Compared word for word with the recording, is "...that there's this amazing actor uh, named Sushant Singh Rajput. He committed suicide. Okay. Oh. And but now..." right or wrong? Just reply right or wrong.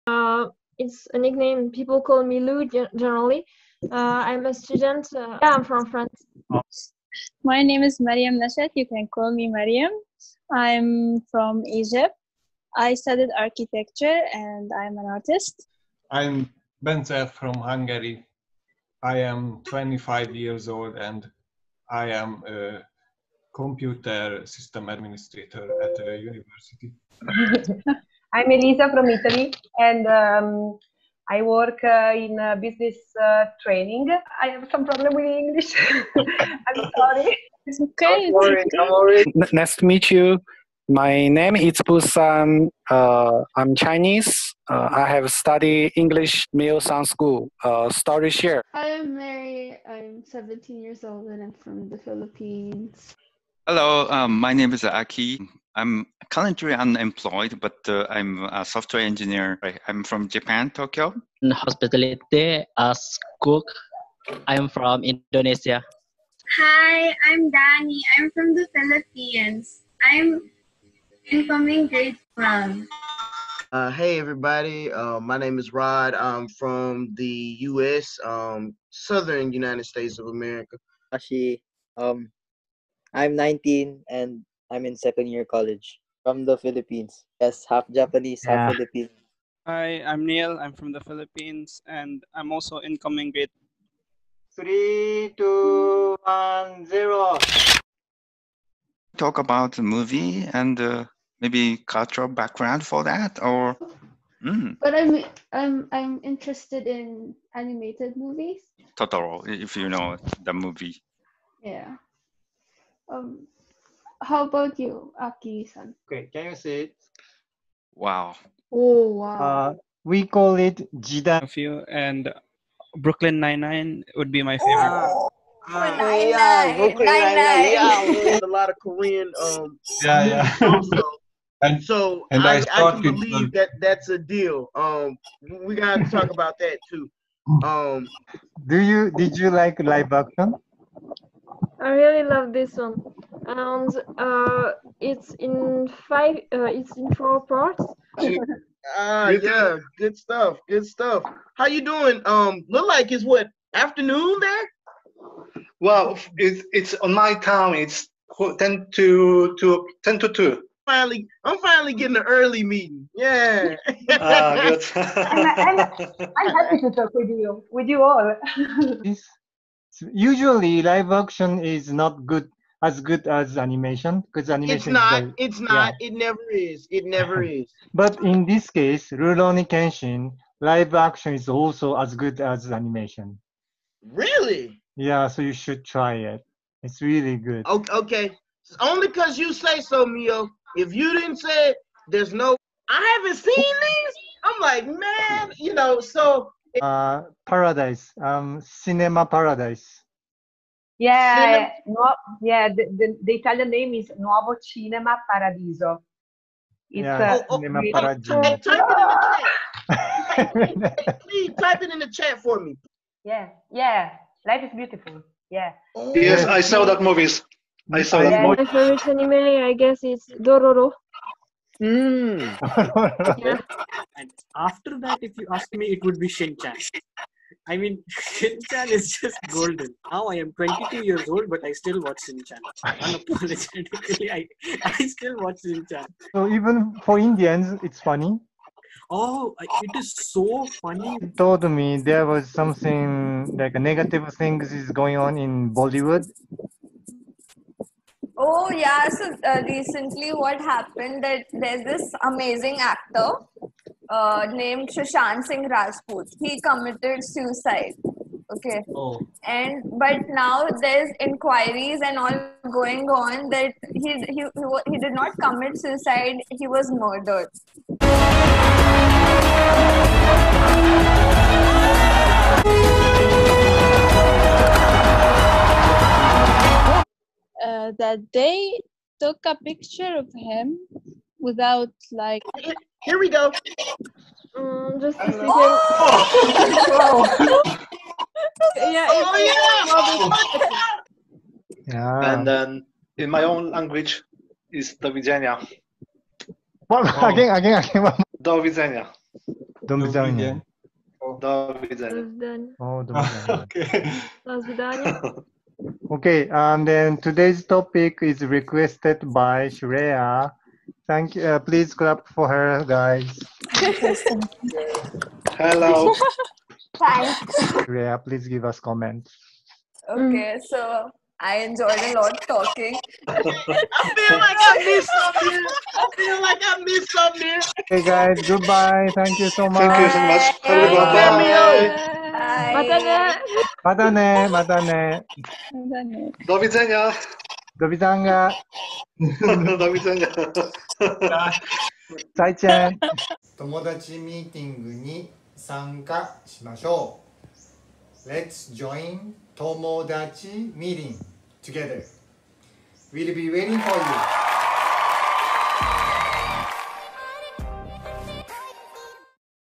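right.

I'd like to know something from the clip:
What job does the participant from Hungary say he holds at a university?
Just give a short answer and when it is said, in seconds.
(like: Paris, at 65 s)
Computer system administrator, at 23 s.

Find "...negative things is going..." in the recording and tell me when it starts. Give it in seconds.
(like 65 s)
243 s.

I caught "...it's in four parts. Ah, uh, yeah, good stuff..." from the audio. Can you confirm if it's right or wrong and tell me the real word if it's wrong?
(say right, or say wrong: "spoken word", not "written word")
right.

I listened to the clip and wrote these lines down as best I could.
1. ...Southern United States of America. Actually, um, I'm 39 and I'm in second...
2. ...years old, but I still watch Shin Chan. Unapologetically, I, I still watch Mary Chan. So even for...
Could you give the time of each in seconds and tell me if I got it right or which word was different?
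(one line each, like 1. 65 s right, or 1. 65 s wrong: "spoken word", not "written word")
1. 78 s wrong: "19", not "39"
2. 231 s wrong: "Shin", not "Mary".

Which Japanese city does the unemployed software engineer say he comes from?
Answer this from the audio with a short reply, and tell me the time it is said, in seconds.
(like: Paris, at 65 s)
Tokyo, at 60 s.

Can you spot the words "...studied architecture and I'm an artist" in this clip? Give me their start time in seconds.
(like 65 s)
12 s.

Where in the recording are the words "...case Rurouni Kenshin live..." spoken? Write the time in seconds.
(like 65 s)
178 s.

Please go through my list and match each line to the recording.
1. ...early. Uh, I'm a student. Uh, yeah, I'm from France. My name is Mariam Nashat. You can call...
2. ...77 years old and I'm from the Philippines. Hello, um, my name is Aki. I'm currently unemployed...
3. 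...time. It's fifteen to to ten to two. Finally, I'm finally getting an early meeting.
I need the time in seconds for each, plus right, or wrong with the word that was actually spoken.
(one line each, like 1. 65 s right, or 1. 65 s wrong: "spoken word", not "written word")
1. 3 s wrong: "generally", not "early"
2. 50 s wrong: "17", not "77"
3. 157 s wrong: "ten", not "fifteen".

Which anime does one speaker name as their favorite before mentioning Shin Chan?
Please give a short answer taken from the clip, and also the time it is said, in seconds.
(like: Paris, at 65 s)
Dororo, at 220 s.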